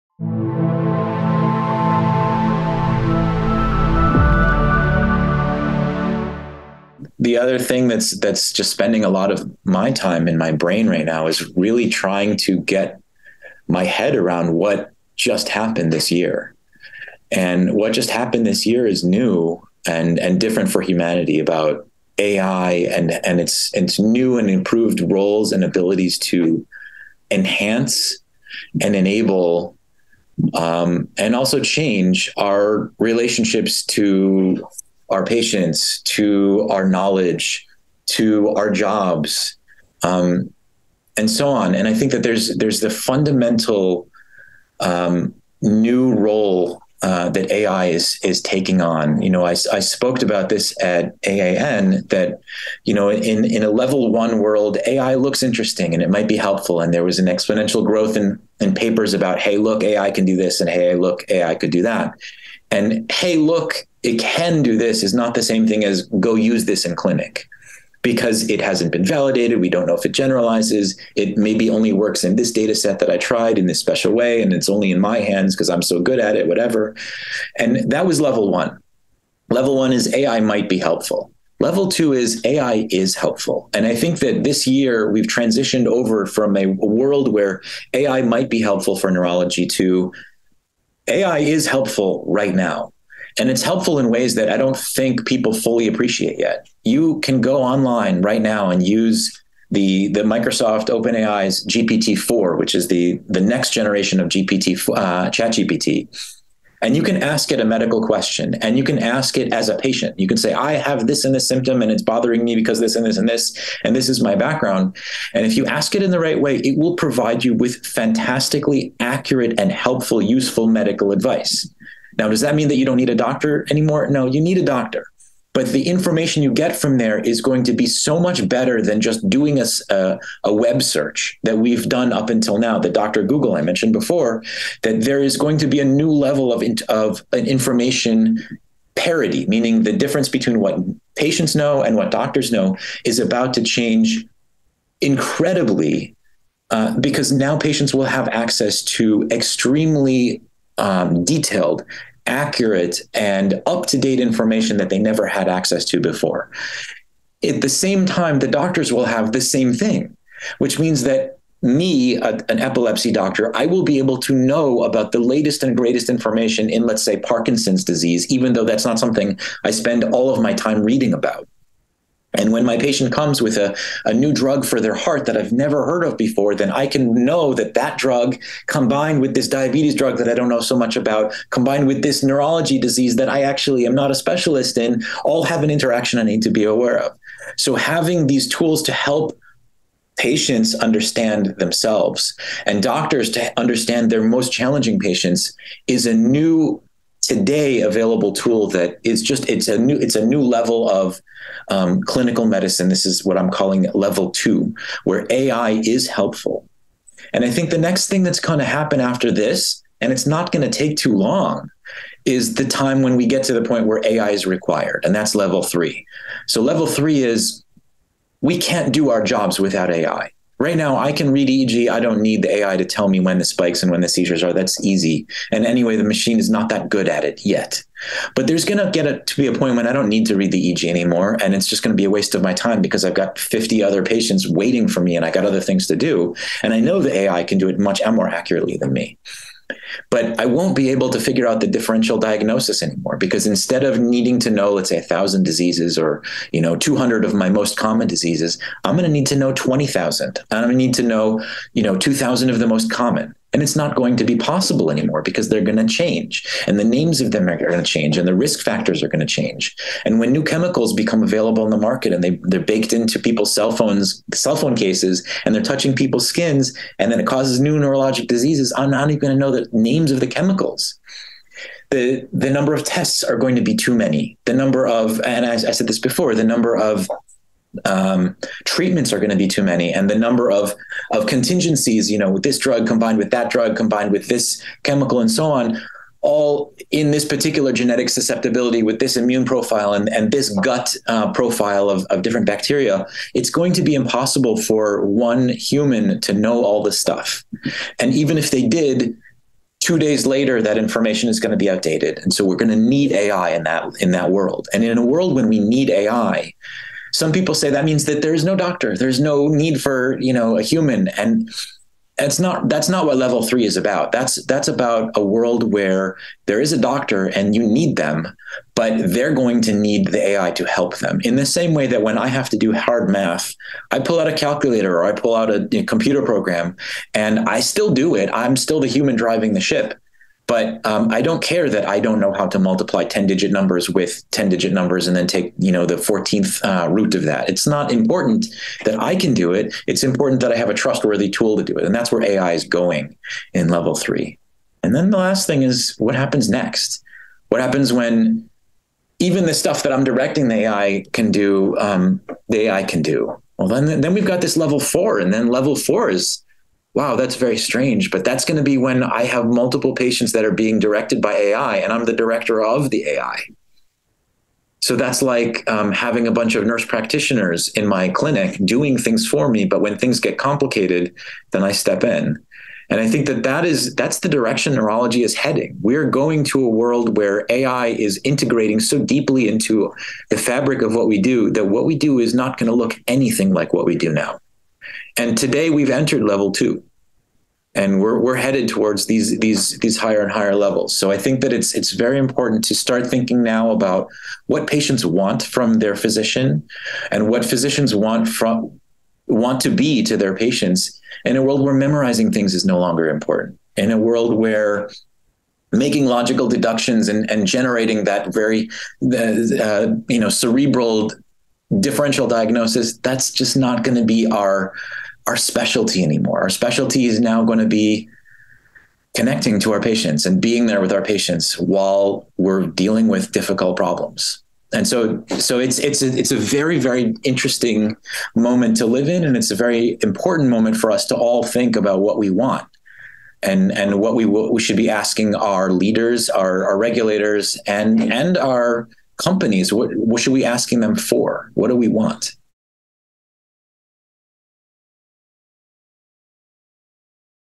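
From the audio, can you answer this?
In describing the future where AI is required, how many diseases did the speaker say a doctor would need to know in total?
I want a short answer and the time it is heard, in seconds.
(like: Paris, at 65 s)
20,000, at 249 s.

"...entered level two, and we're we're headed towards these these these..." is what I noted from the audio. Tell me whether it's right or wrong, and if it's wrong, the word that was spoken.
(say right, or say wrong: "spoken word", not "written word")
right.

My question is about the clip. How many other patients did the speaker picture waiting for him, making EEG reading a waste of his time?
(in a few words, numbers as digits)
50.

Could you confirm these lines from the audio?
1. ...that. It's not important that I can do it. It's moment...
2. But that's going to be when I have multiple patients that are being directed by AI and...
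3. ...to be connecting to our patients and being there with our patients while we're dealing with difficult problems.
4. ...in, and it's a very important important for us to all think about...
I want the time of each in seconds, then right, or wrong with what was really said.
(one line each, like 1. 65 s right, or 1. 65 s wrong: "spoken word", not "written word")
1. 337 s wrong: "important", not "moment"
2. 358 s right
3. 417 s right
4. 429 s wrong: "moment", not "important".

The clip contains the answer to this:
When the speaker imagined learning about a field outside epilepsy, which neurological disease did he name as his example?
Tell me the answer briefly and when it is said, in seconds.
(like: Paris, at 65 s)
Parkinson's disease, at 167 s.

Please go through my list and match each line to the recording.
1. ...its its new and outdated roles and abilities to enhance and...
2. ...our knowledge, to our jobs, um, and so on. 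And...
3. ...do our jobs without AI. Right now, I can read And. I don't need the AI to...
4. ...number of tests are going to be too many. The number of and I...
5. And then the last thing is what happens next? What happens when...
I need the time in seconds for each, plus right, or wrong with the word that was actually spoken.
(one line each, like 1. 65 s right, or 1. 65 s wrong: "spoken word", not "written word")
1. 23 s wrong: "improved", not "outdated"
2. 36 s right
3. 218 s wrong: "EEG", not "And"
4. 272 s right
5. 344 s right.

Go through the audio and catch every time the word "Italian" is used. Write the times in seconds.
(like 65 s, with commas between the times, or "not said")
not said.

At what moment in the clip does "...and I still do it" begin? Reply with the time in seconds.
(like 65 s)
327 s.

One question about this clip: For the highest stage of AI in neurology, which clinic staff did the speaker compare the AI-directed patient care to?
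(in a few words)
nurse practitioners.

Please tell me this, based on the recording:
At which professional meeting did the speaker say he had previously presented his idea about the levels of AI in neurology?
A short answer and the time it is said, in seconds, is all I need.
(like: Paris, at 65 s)
AAN, at 51 s.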